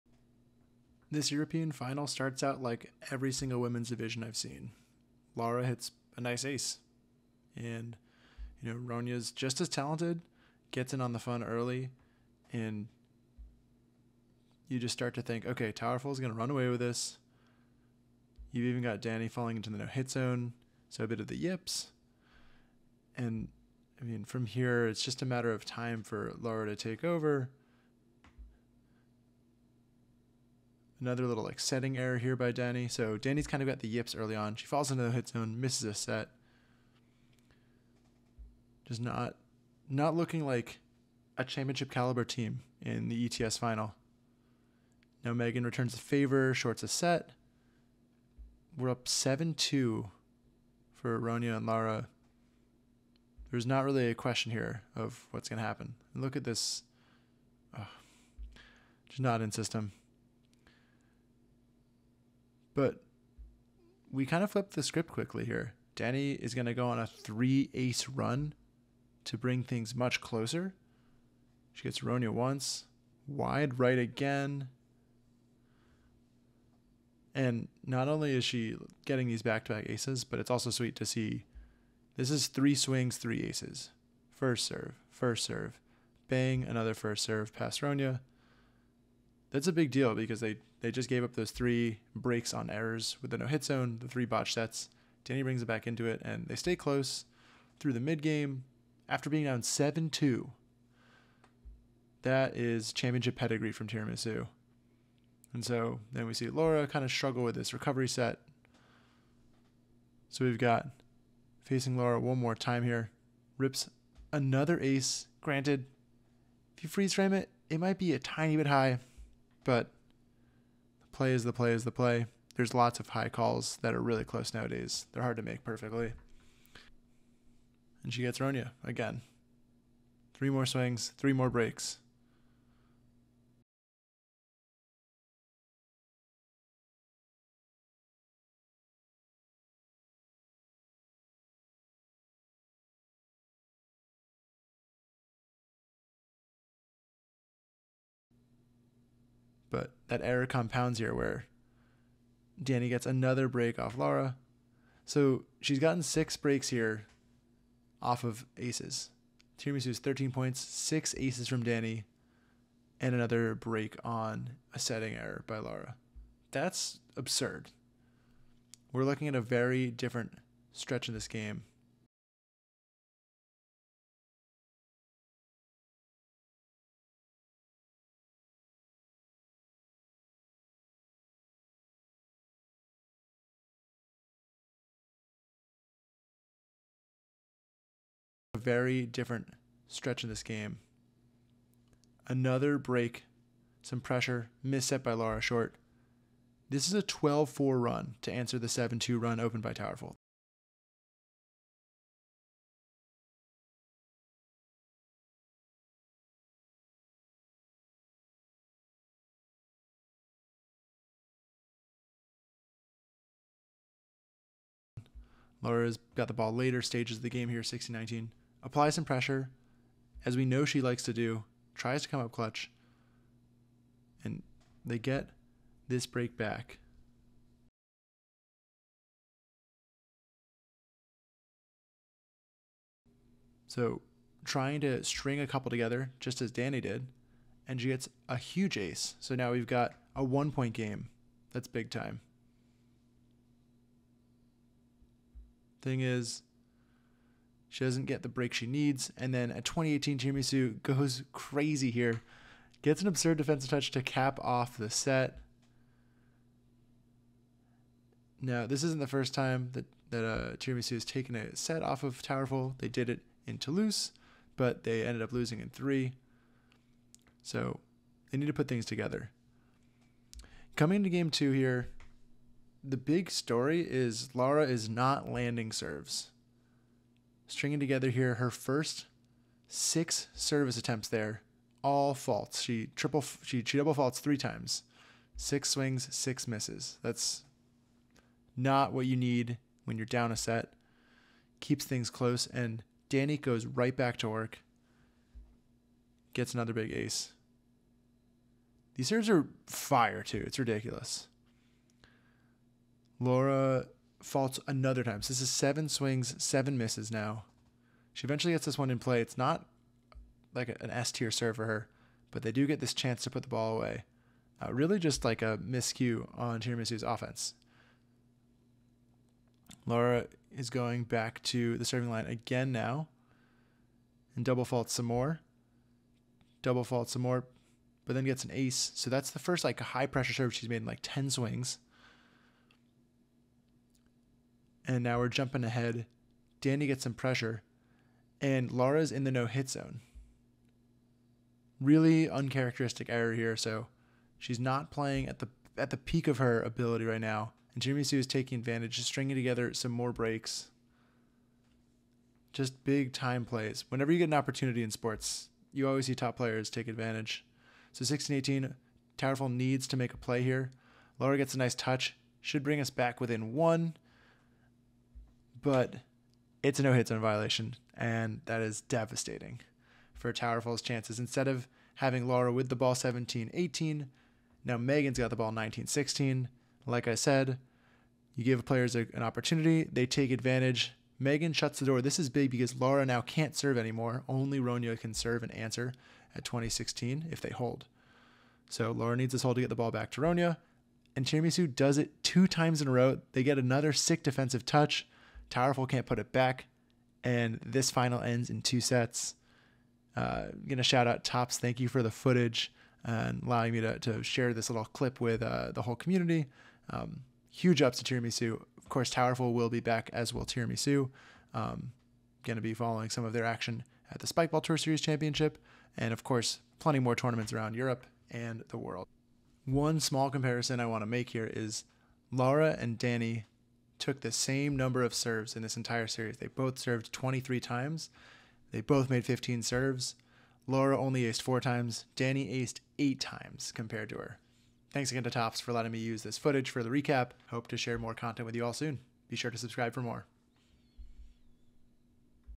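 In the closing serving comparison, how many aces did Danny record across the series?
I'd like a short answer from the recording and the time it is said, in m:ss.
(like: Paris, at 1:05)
8, at 7:12.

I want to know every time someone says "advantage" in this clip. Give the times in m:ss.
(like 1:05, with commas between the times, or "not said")
5:48, 5:56, 6:20.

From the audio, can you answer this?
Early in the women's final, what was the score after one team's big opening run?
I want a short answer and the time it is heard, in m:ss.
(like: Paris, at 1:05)
7-2, at 0:49.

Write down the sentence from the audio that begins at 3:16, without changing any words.
This is a 12 4 run to answer the 7 2 run opened by Towerful.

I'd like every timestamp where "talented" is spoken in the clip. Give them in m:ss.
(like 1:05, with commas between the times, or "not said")
0:09.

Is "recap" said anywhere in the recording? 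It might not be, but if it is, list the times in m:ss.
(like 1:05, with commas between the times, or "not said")
7:16.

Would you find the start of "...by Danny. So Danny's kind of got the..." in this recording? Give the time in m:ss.
0:32.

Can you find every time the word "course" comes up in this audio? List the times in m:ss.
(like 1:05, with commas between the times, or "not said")
6:48, 6:56.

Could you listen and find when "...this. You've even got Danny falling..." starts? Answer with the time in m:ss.
0:16.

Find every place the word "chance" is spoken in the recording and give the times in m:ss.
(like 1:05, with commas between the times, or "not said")
5:12, 6:10.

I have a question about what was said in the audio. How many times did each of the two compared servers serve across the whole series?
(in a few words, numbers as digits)
23.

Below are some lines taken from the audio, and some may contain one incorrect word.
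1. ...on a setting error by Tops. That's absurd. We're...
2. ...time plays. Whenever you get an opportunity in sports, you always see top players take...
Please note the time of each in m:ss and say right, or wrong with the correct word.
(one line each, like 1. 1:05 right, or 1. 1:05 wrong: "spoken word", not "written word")
1. 2:44 wrong: "Lara", not "Tops"
2. 5:53 right.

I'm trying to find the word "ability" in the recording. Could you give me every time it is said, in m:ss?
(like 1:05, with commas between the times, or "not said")
5:46.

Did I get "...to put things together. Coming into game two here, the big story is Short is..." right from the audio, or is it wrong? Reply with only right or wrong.
wrong.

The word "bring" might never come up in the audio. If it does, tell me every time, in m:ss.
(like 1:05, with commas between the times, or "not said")
1:09, 1:35, 6:02.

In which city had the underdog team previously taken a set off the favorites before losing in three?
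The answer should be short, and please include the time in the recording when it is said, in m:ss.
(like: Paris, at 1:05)
Toulouse, at 4:23.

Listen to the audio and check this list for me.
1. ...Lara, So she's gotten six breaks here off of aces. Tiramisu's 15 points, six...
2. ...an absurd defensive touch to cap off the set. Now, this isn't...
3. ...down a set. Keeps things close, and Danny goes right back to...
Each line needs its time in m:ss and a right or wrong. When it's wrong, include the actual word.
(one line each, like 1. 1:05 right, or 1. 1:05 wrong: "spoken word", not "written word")
1. 2:33 wrong: "13", not "15"
2. 4:13 right
3. 4:50 right.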